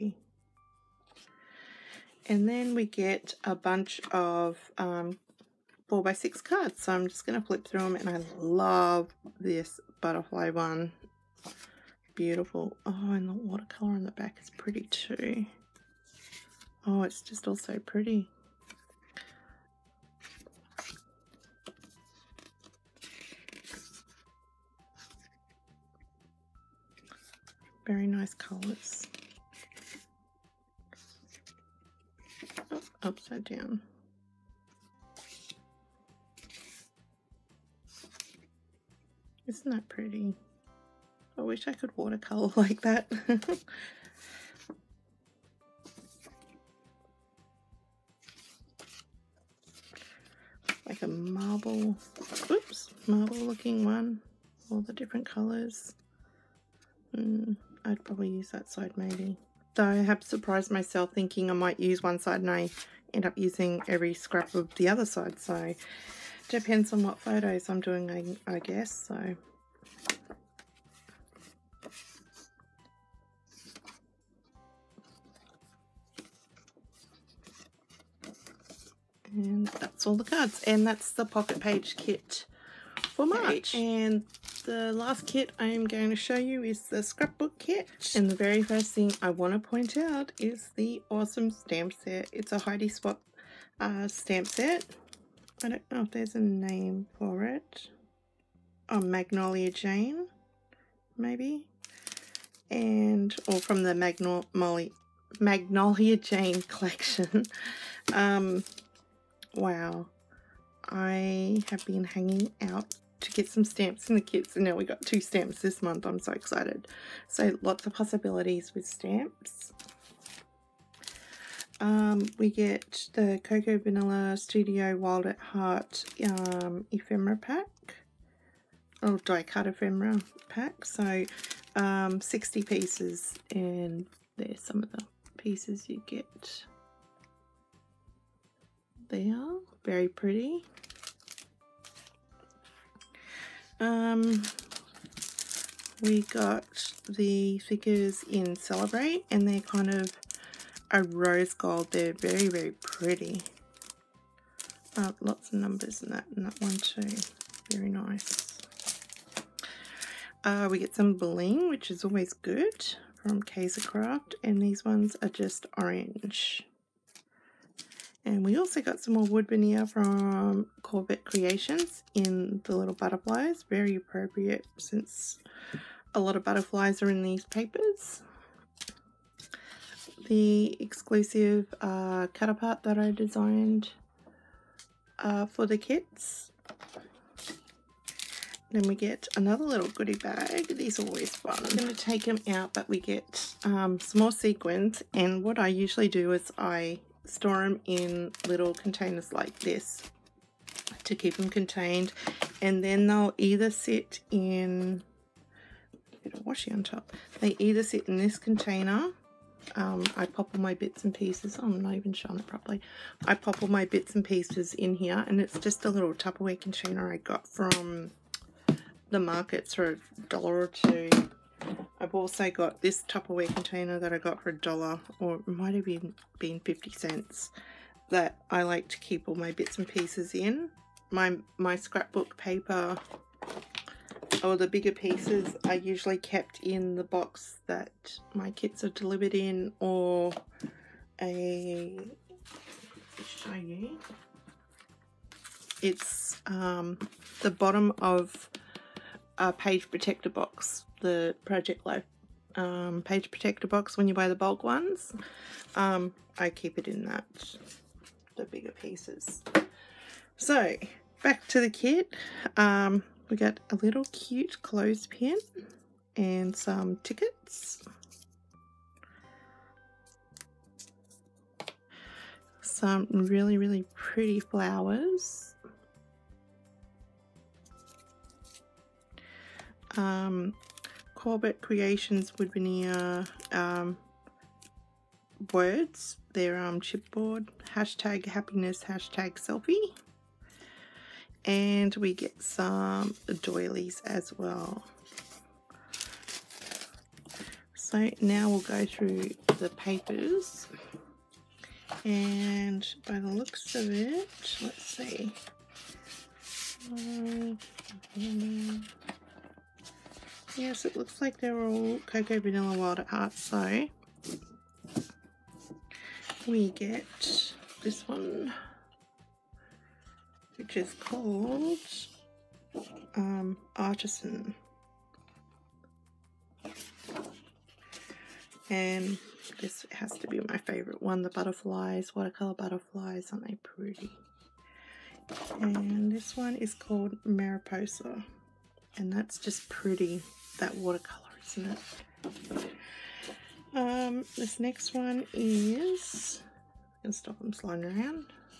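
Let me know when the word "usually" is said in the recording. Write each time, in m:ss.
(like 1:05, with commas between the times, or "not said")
3:15, 3:55.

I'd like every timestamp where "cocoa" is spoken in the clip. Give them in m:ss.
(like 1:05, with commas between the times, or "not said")
2:03, 5:12.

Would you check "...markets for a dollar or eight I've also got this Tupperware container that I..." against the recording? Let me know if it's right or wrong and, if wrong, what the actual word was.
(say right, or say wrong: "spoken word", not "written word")
wrong: "two", not "eight".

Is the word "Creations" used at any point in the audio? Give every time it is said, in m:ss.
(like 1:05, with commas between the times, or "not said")
2:51, 4:41.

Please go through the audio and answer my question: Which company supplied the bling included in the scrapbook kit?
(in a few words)
Kaisercraft.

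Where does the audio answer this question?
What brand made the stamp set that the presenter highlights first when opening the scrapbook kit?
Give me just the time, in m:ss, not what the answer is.
1:32.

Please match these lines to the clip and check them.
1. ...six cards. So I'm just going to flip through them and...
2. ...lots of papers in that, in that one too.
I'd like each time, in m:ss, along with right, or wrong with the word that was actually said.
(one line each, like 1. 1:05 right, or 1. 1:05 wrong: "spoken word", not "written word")
1. 0:06 right
2. 2:35 wrong: "numbers", not "papers".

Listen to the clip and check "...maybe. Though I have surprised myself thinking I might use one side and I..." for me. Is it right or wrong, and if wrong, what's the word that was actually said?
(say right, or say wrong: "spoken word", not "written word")
right.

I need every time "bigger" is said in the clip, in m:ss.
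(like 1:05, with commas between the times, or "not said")
3:54, 4:18.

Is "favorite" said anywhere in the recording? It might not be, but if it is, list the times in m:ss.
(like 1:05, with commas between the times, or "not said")
5:30.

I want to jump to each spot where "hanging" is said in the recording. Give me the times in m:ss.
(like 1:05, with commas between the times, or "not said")
1:52.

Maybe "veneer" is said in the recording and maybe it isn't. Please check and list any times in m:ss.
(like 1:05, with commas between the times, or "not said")
2:49.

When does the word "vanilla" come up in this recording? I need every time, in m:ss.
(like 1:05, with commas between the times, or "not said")
2:03, 5:12.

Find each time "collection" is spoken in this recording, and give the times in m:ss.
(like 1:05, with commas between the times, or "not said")
1:46.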